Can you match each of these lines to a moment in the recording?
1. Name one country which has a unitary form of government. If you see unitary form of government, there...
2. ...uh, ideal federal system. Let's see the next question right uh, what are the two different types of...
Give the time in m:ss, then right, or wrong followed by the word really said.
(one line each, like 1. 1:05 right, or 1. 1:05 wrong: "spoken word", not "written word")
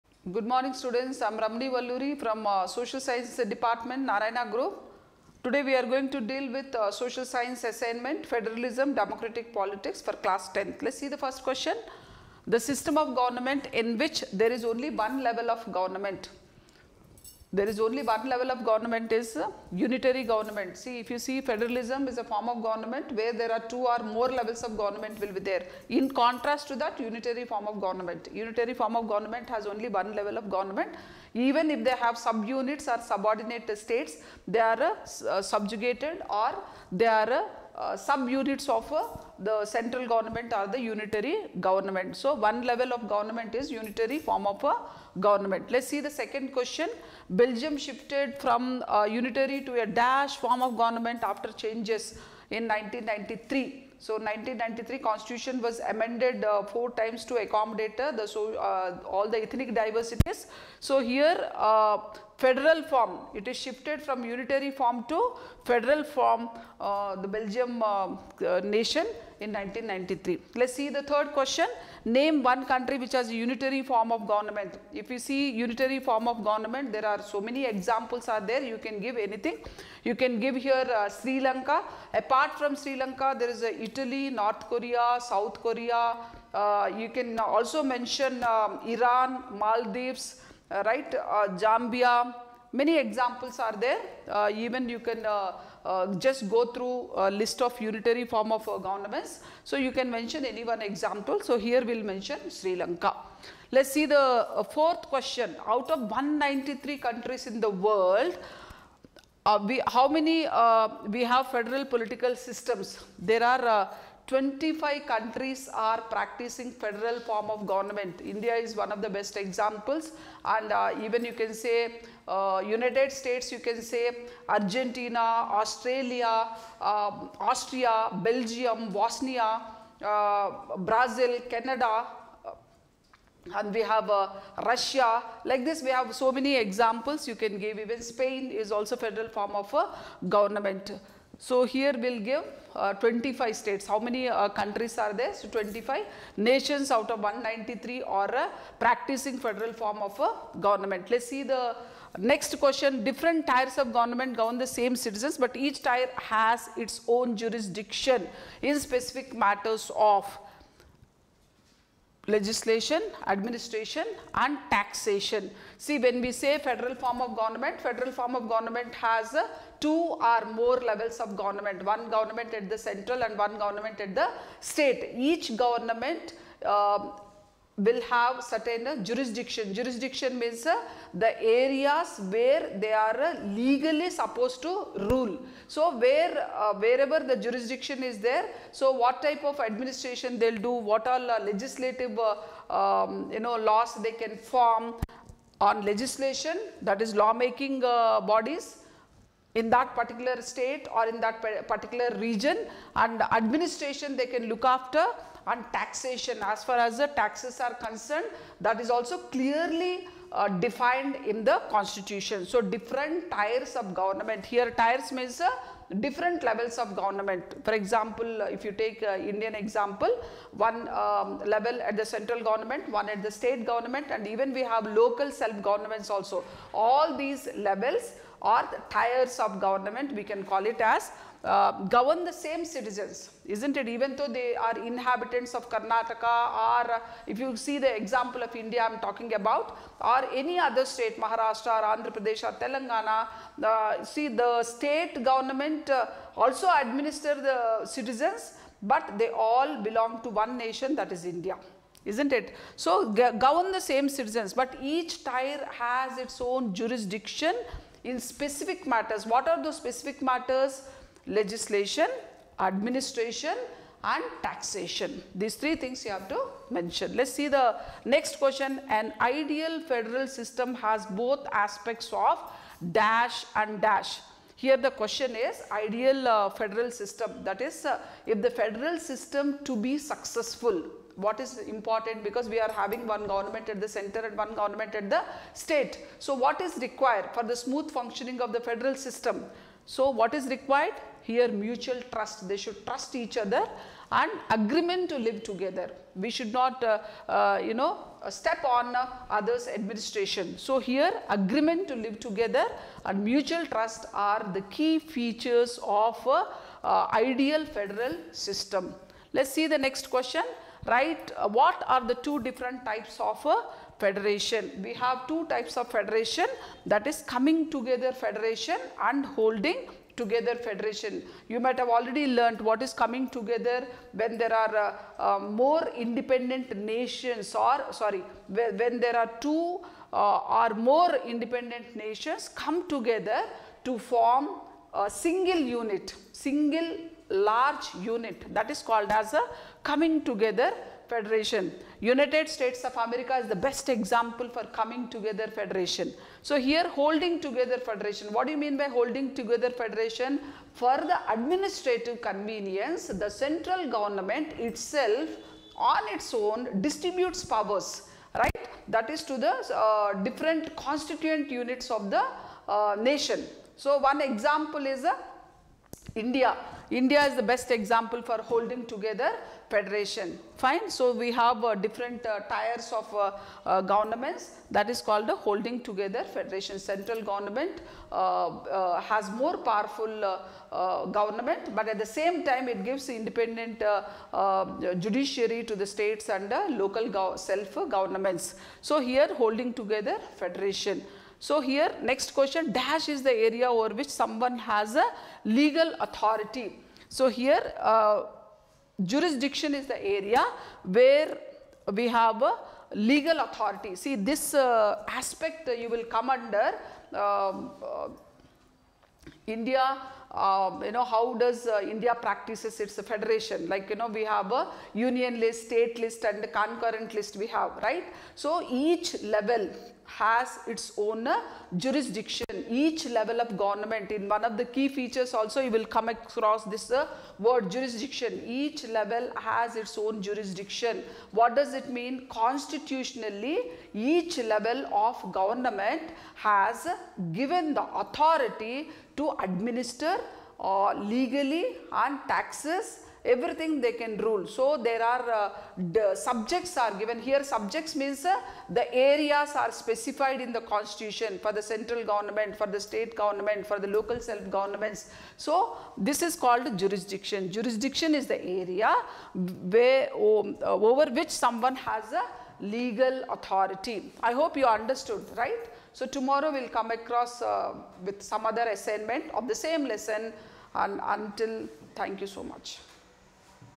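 1. 1:12 right
2. 5:06 right.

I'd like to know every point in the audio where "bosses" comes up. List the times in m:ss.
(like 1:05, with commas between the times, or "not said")
not said.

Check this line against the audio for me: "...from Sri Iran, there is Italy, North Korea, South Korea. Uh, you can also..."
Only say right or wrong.
wrong.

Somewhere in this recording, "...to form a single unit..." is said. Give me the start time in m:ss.
5:33.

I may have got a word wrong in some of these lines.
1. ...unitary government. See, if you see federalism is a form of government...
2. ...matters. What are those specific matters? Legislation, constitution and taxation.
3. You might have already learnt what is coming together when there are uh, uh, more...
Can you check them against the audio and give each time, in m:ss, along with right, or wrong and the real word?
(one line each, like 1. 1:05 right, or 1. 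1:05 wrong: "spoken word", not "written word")
1. 0:19 right
2. 4:18 wrong: "administration", not "constitution"
3. 5:21 right.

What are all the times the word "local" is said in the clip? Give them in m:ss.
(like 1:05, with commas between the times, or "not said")
3:44, 6:26, 7:33.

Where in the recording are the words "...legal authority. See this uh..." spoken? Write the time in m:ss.
6:42.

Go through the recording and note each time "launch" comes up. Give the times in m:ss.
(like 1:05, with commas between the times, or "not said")
not said.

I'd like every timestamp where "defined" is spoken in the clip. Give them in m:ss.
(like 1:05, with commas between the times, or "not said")
3:30.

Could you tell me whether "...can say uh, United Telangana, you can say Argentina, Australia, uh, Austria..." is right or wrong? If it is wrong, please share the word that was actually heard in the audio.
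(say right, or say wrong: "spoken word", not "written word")
wrong: "States", not "Telangana".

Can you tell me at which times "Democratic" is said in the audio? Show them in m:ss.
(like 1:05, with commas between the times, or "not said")
0:08.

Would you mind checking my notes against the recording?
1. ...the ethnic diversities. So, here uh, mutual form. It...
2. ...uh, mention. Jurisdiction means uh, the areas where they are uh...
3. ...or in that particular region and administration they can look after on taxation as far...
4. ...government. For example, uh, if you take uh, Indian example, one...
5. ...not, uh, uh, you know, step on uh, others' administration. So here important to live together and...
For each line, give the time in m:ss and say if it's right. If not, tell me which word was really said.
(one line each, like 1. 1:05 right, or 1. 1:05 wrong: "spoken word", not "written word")
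1. 0:59 wrong: "federal", not "mutual"
2. 2:58 wrong: "jurisdiction", not "mention"
3. 3:20 right
4. 3:36 right
5. 4:56 wrong: "agreement", not "important".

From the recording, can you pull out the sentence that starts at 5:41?
United States of America is the best example for coming together federation.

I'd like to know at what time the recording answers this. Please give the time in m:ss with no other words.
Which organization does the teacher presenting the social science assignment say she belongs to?
0:04.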